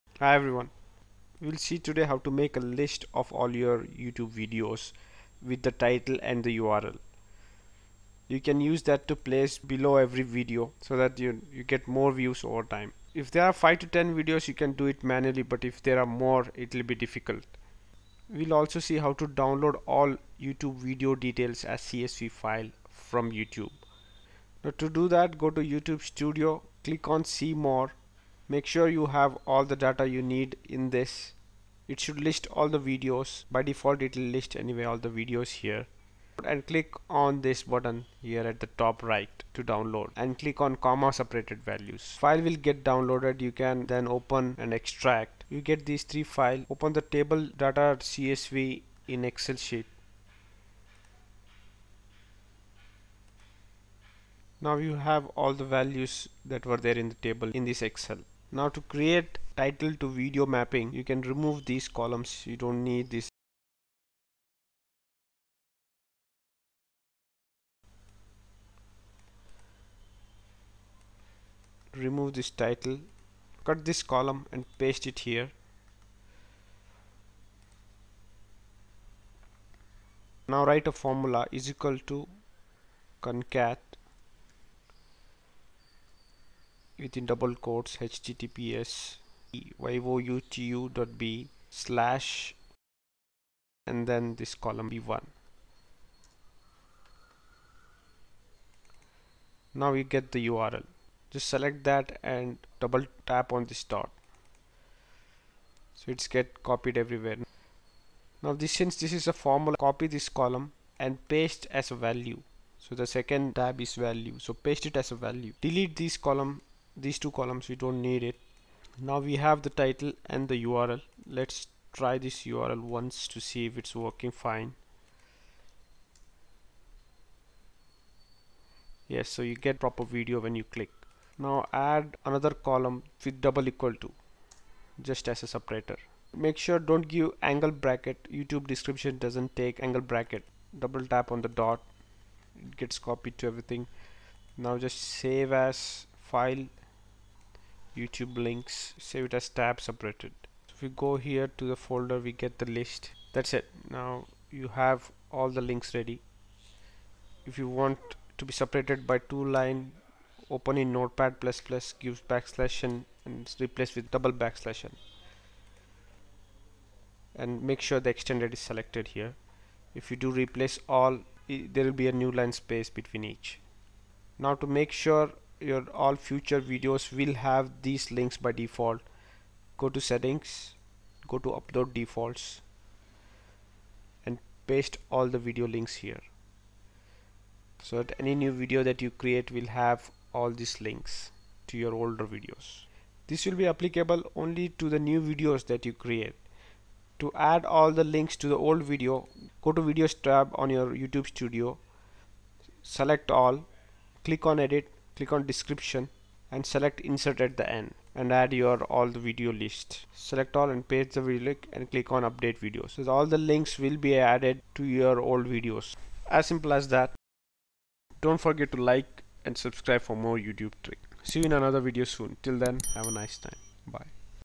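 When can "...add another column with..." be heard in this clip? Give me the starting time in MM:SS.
02:11.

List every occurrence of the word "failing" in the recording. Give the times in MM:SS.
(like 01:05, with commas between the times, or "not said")
not said.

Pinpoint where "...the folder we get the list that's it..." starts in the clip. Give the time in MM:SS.
02:31.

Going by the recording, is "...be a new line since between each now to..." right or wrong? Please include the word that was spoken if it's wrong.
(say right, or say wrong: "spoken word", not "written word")
wrong: "space", not "since".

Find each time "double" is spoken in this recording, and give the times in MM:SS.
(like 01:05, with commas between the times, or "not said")
01:27, 01:42, 02:13, 02:20, 02:44.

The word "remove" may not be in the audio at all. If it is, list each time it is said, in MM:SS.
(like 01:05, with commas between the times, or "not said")
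01:01, 01:11.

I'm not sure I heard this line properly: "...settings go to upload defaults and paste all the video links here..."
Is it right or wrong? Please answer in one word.
right.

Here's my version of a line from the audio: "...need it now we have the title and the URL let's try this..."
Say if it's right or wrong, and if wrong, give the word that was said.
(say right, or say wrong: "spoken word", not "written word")
right.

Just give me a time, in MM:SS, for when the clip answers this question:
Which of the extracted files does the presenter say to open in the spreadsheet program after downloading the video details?
00:47.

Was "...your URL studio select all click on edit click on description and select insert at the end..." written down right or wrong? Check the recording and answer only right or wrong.
wrong.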